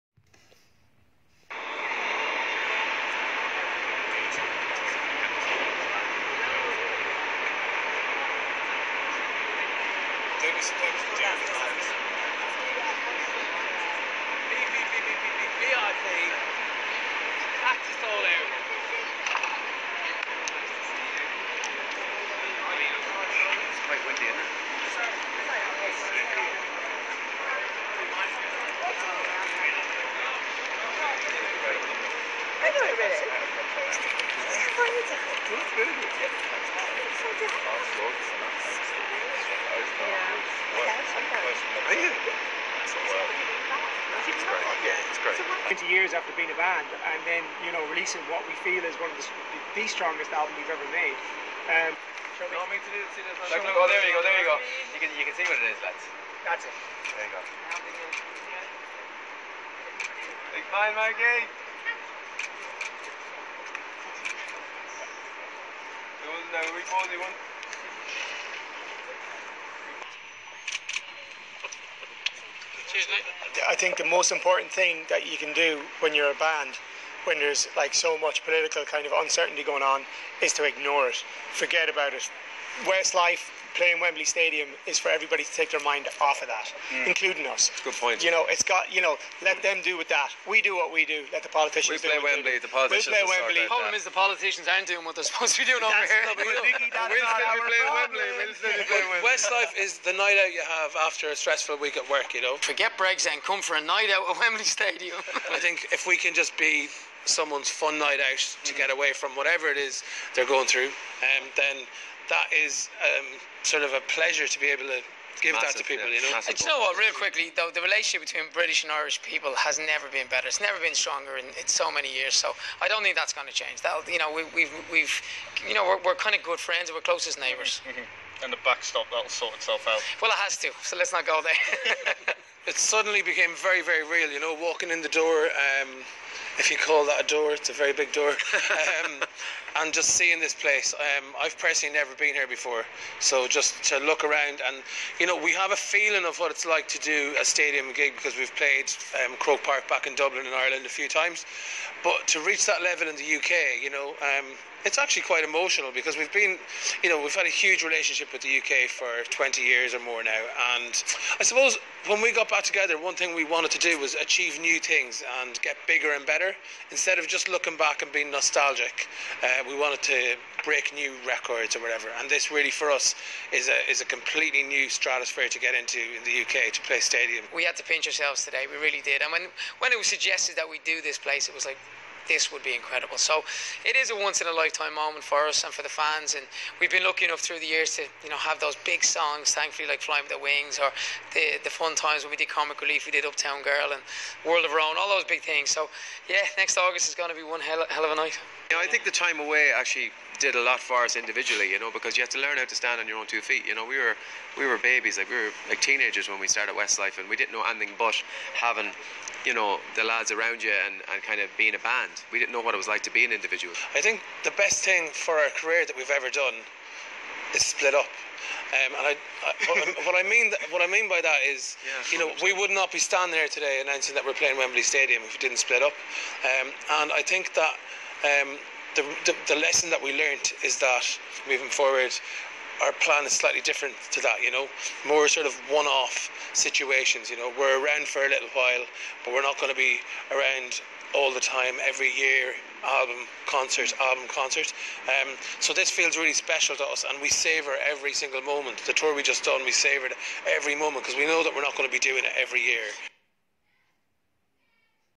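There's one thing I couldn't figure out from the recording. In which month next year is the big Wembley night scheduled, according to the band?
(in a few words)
August.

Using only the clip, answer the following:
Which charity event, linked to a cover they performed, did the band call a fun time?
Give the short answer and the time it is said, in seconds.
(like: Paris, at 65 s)
Comic Relief, at 192 s.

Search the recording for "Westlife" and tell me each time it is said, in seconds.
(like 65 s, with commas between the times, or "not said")
82 s, 99 s, 206 s.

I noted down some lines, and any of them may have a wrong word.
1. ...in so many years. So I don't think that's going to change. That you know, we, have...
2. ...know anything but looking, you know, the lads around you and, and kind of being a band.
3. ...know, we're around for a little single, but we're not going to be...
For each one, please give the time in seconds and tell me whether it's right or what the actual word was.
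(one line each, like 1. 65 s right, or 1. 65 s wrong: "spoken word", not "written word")
1. 121 s right
2. 207 s wrong: "having", not "looking"
3. 237 s wrong: "while", not "single".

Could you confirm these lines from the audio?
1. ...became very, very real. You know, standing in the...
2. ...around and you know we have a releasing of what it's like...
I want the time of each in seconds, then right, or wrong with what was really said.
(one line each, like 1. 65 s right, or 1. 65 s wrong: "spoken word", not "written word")
1. 133 s wrong: "walking", not "standing"
2. 144 s wrong: "feeling", not "releasing".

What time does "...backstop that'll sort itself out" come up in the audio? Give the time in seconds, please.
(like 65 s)
128 s.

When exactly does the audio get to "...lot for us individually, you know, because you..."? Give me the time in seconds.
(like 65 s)
200 s.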